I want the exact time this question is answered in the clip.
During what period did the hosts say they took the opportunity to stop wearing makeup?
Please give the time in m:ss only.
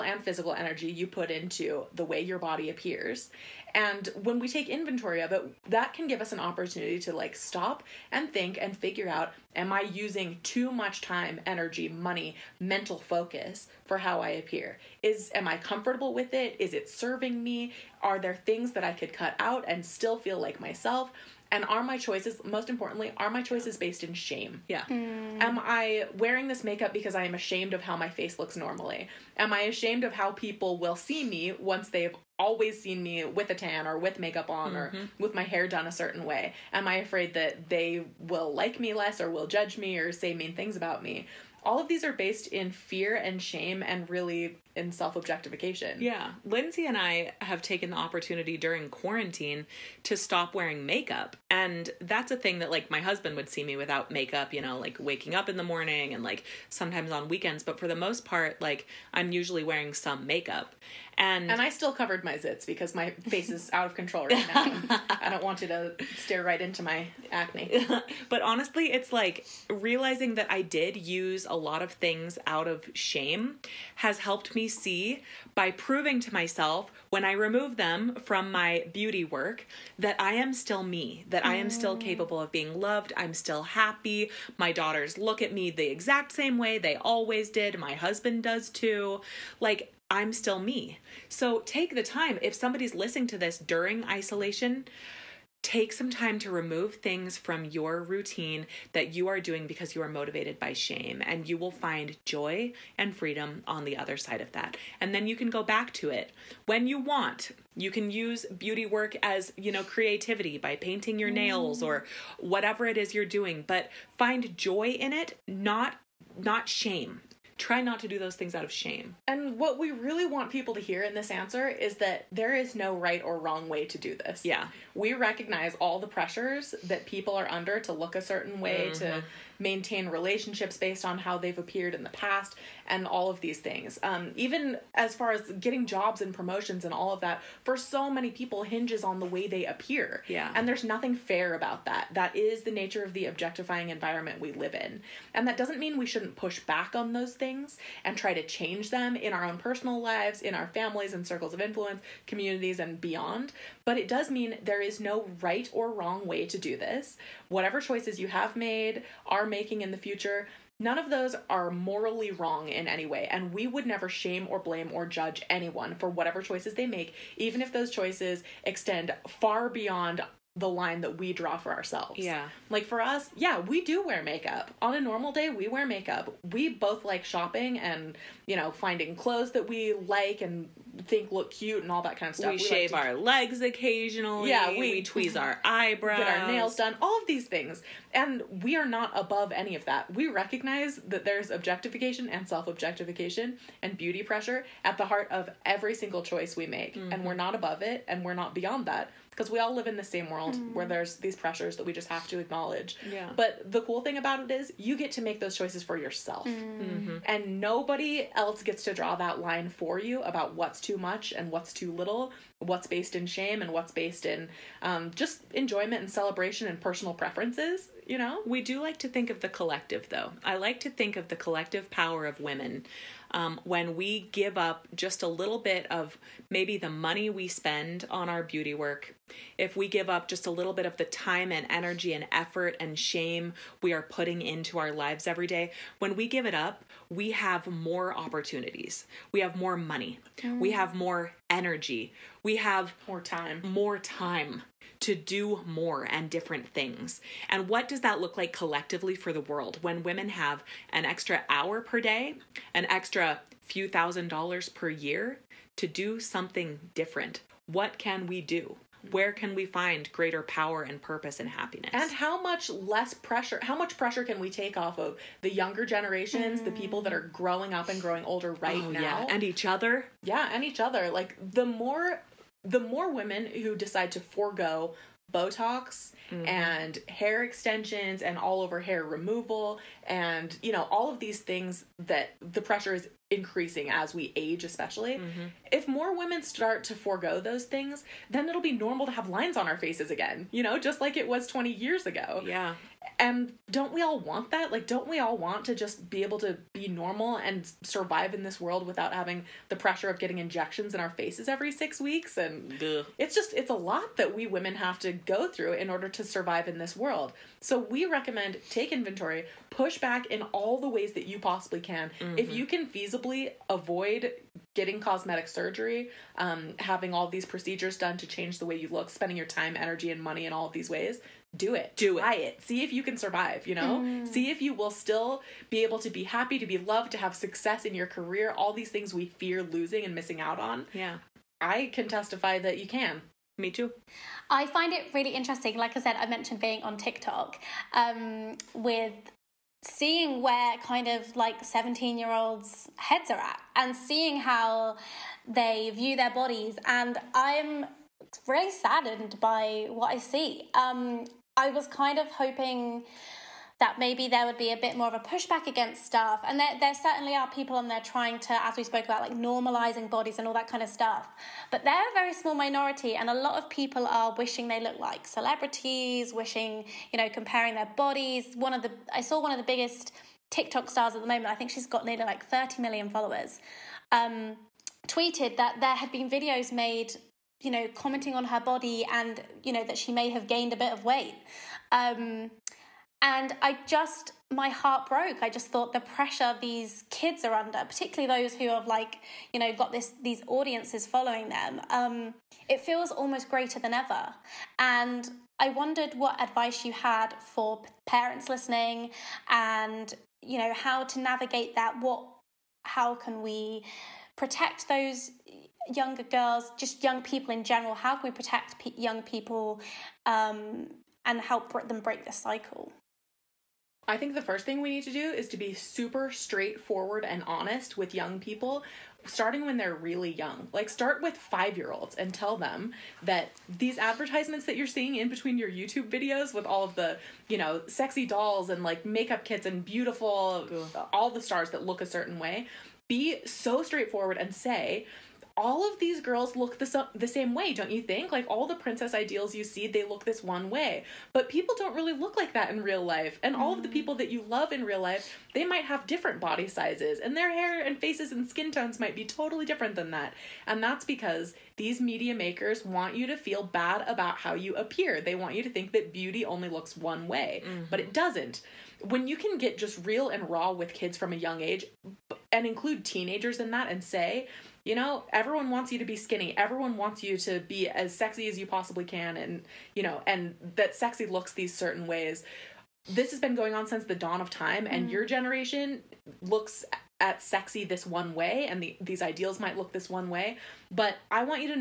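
0:48.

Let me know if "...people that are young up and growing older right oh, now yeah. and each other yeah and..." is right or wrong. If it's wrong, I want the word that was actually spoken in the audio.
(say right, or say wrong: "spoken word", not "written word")
wrong: "growing", not "young".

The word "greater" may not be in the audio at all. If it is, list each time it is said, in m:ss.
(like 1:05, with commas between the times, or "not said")
4:20, 6:33.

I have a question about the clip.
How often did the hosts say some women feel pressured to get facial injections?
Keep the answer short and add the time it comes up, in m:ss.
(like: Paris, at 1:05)
Every 6 weeks, at 5:01.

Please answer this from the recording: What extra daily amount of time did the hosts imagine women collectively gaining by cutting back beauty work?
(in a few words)
An extra hour.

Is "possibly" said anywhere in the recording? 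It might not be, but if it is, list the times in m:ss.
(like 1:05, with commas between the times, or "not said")
5:11, 7:48.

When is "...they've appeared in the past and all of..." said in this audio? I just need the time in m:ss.
2:11.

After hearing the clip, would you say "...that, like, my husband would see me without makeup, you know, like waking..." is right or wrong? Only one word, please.
right.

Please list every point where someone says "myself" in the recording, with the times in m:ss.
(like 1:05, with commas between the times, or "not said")
0:20, 1:16.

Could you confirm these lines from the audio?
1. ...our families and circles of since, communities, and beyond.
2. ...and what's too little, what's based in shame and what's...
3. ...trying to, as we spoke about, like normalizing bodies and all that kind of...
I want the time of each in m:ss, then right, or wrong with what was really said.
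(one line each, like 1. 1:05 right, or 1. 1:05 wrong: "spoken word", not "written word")
1. 2:30 wrong: "influence", not "since"
2. 3:31 right
3. 5:57 right.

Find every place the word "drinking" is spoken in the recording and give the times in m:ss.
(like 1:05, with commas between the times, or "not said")
not said.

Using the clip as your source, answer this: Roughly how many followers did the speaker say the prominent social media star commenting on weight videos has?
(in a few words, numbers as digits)
30 million.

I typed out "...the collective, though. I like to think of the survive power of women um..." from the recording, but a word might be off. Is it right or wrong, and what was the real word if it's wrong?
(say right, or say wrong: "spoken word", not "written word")
wrong: "collective", not "survive".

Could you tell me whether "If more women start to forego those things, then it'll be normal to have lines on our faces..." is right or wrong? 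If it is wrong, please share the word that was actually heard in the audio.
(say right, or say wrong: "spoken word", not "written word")
right.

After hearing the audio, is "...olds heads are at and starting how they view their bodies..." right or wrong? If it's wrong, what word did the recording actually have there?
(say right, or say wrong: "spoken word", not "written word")
wrong: "seeing", not "starting".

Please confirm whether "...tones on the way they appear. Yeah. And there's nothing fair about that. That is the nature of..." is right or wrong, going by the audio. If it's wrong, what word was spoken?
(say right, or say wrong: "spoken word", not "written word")
wrong: "hinges", not "tones".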